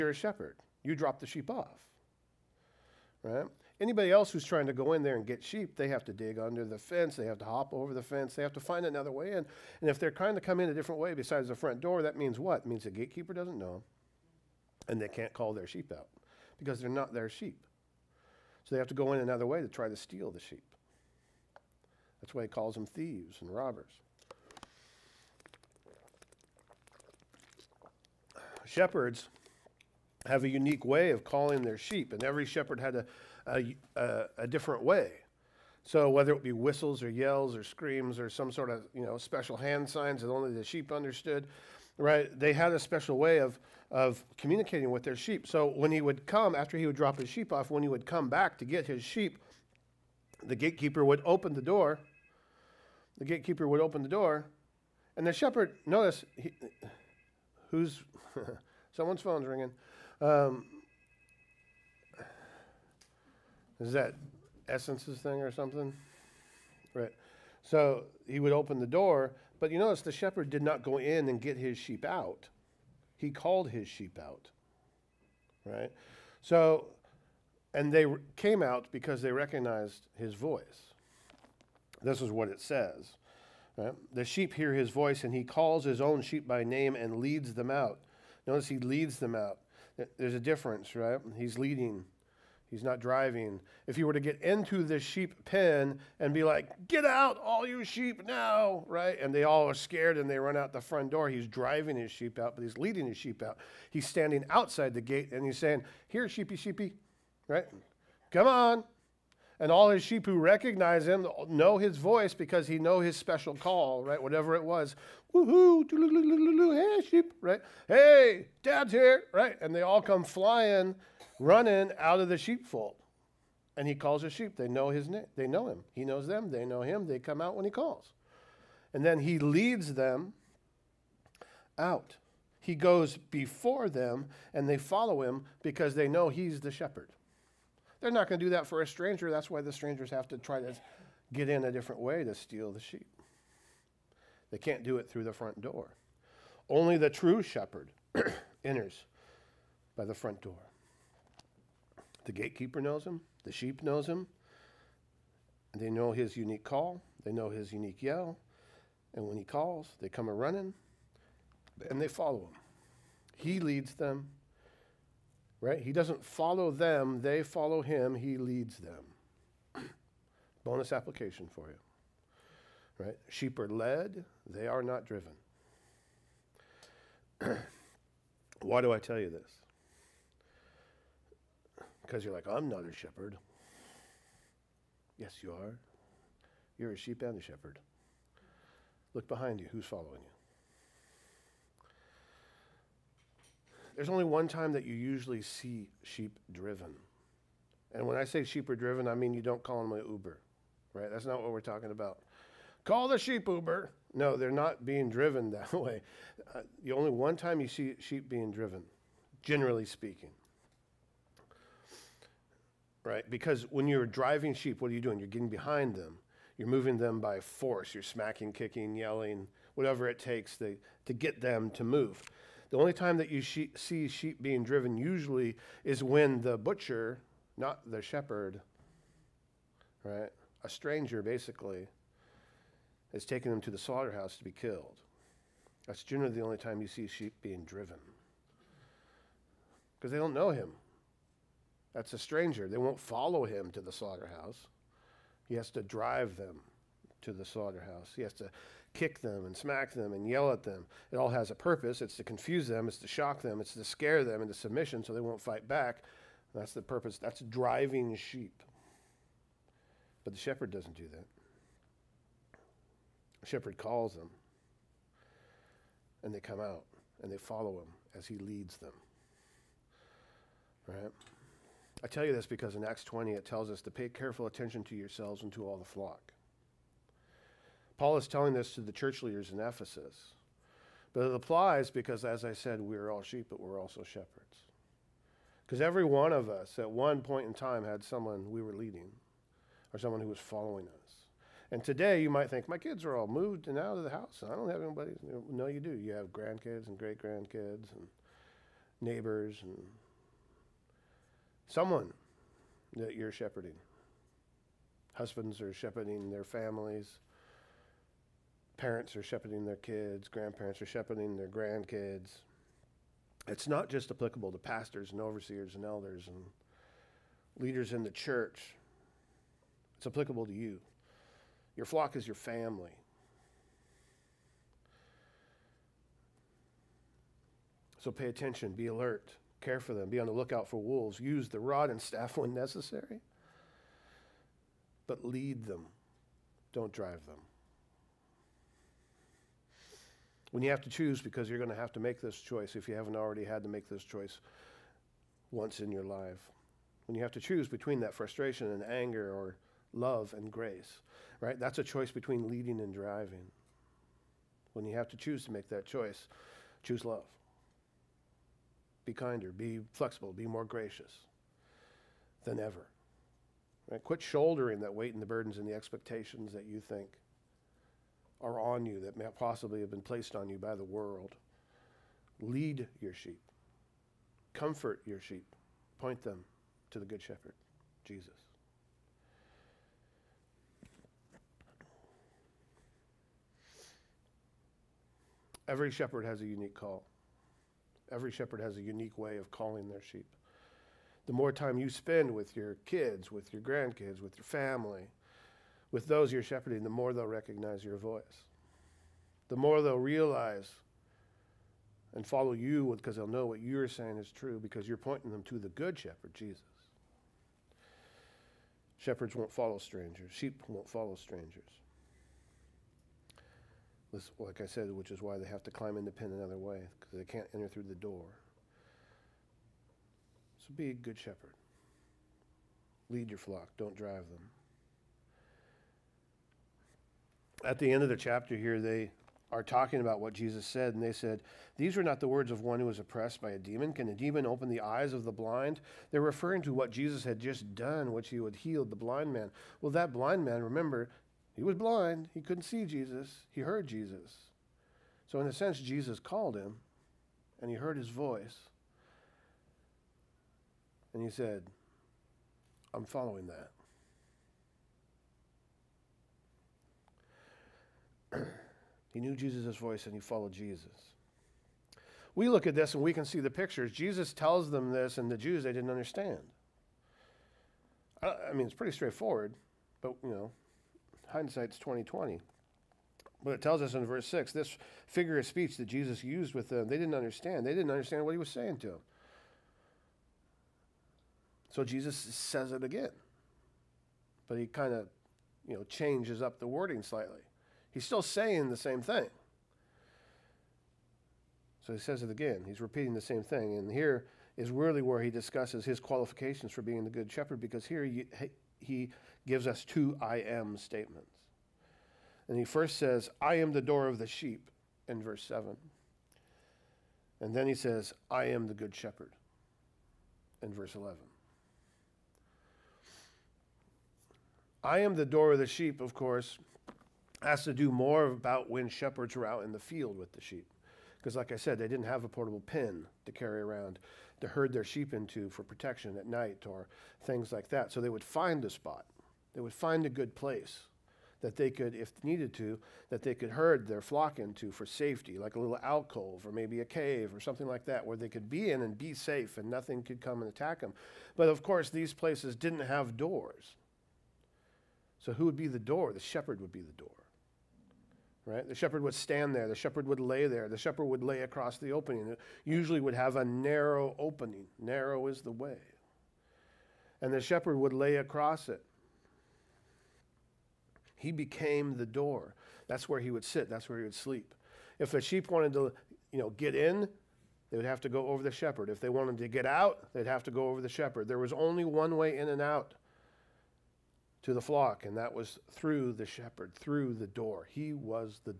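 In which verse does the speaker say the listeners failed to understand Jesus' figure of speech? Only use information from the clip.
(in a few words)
verse 6.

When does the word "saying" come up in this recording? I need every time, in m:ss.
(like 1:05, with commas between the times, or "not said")
1:45, 6:43, 7:58, 8:08.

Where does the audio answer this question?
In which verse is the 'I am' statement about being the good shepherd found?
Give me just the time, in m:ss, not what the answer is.
8:30.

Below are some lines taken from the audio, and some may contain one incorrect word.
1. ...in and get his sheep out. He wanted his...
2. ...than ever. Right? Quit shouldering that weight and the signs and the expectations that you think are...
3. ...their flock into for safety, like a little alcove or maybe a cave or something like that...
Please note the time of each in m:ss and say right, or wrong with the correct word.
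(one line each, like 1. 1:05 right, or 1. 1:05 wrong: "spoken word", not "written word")
1. 1:10 wrong: "called", not "wanted"
2. 6:02 wrong: "burdens", not "signs"
3. 8:53 right.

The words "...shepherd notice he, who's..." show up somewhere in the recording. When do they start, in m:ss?
0:55.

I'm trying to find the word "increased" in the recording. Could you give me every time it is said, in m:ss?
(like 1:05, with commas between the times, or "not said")
not said.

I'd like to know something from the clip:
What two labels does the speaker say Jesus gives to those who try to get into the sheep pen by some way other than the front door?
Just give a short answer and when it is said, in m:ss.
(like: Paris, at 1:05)
thieves and robbers, at 0:22.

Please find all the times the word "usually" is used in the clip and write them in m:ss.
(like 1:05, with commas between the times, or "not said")
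3:14, 3:44, 9:12.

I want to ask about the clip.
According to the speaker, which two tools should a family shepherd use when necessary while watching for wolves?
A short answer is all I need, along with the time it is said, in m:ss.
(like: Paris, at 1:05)
rod and staff, at 5:31.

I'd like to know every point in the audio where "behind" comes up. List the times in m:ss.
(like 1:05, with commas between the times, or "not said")
3:09, 3:35.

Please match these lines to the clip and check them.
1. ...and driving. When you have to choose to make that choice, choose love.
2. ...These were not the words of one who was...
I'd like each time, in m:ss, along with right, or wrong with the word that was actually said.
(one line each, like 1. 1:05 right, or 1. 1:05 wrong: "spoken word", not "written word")
1. 5:52 right
2. 7:11 right.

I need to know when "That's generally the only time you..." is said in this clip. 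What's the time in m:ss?
3:55.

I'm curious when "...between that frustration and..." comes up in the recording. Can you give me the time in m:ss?
5:47.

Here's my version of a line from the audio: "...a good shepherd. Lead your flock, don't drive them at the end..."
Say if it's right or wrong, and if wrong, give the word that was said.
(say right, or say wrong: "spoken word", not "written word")
right.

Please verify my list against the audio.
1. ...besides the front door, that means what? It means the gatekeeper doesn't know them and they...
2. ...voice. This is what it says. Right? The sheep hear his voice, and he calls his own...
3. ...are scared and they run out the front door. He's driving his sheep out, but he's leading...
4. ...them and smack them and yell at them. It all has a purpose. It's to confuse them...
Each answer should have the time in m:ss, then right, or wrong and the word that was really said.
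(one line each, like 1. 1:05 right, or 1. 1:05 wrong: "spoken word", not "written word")
1. 0:11 right
2. 1:20 right
3. 1:39 right
4. 4:09 right.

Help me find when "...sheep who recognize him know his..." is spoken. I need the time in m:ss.
1:50.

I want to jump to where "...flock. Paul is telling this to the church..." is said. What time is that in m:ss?
4:35.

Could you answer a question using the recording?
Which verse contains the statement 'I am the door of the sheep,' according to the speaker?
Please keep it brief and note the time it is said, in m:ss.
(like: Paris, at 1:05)
verse 7, at 8:25.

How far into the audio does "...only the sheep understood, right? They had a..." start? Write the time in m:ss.
0:40.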